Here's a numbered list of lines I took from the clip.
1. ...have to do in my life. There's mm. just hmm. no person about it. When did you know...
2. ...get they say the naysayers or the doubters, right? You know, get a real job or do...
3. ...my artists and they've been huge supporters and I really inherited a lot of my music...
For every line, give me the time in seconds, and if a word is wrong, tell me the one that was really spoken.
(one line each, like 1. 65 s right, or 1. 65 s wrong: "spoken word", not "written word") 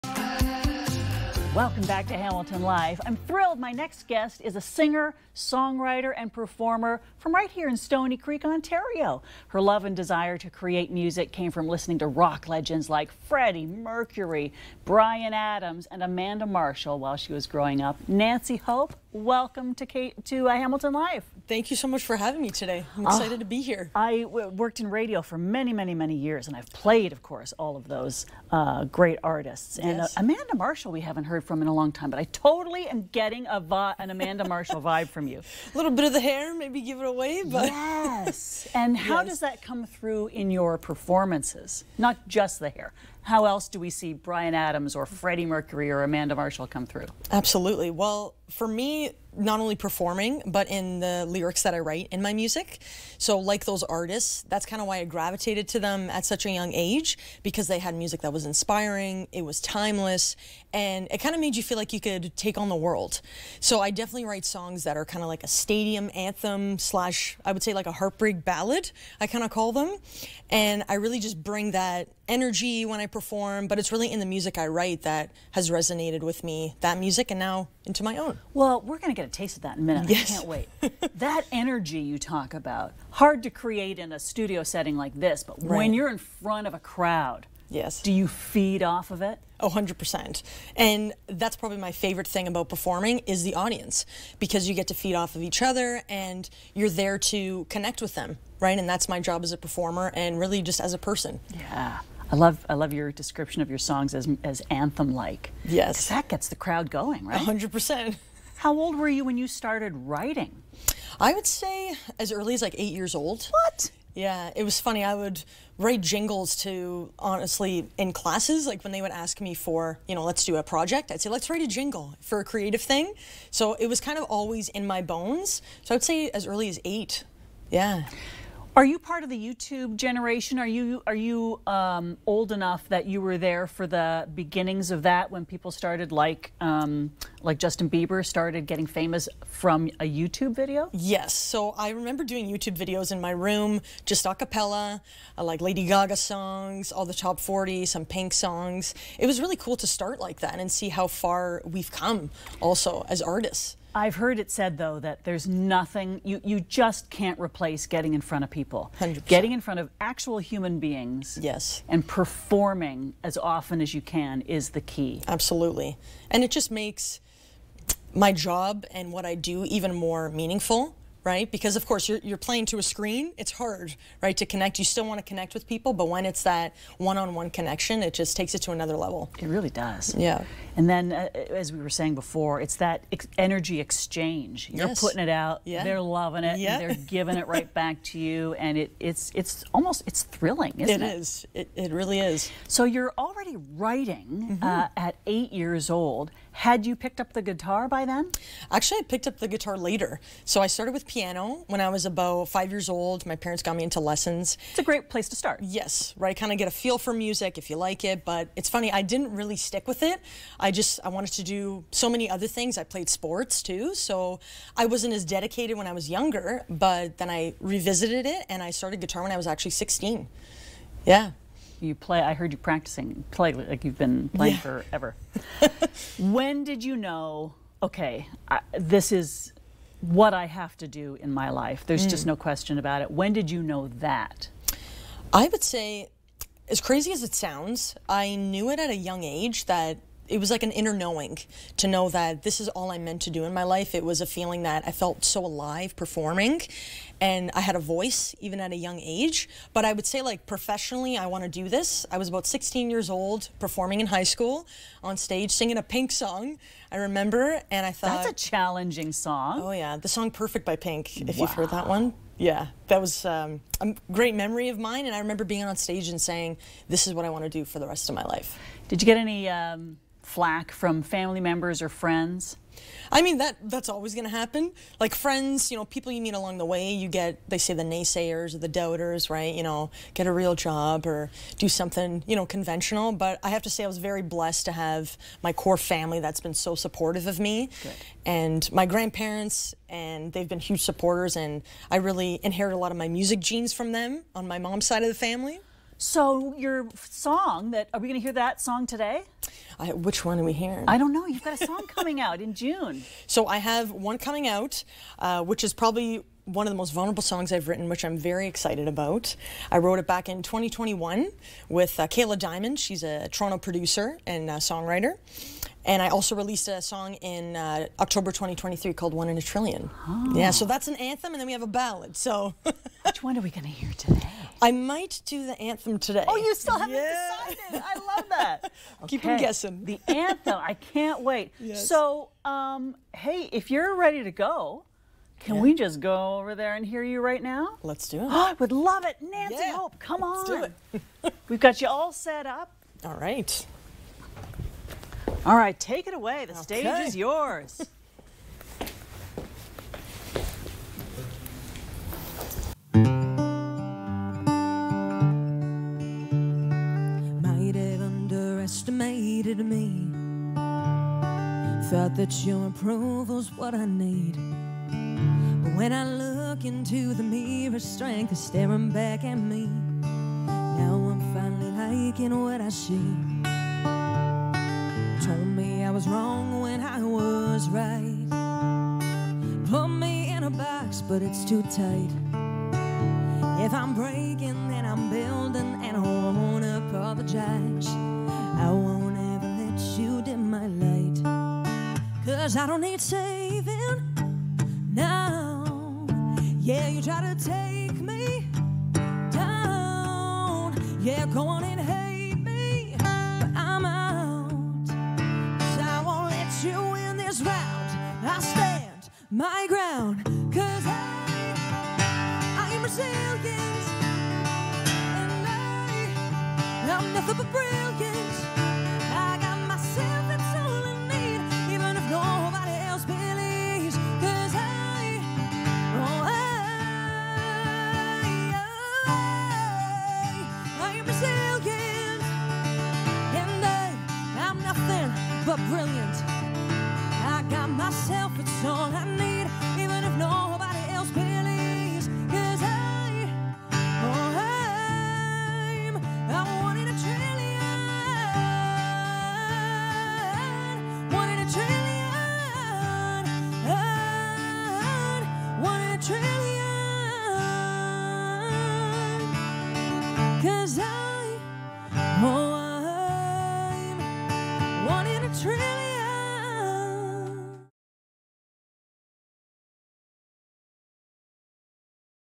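1. 230 s wrong: "question", not "person"
2. 277 s right
3. 288 s wrong: "grandparents", not "artists".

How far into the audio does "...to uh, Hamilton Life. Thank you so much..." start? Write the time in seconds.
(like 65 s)
20 s.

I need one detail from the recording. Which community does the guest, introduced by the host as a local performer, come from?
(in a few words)
Stoney Creek.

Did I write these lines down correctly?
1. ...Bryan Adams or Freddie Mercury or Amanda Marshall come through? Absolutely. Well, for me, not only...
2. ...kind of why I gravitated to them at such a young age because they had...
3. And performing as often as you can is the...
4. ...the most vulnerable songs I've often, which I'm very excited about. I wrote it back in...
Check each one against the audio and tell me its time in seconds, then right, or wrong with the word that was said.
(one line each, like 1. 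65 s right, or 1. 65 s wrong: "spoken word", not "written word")
1. 44 s right
2. 54 s right
3. 161 s right
4. 306 s wrong: "written", not "often".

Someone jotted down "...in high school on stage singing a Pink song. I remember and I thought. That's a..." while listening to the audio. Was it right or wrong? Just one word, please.
right.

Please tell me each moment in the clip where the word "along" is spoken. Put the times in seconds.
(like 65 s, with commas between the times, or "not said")
276 s.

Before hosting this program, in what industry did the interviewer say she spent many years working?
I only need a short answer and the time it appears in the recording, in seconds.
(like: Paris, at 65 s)
radio, at 24 s.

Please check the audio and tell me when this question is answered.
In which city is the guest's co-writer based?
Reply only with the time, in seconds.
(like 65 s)
313 s.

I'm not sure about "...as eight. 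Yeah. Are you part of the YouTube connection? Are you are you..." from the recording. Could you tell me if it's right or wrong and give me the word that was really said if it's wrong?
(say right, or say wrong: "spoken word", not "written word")
wrong: "generation", not "connection".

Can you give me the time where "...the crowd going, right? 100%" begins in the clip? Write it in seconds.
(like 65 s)
106 s.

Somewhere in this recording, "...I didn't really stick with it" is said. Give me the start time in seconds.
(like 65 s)
208 s.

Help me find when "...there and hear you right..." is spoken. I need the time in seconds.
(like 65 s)
336 s.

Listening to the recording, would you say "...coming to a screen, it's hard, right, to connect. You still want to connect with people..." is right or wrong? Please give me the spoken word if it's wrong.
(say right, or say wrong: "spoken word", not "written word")
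wrong: "playing", not "coming".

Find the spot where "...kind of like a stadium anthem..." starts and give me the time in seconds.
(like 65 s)
65 s.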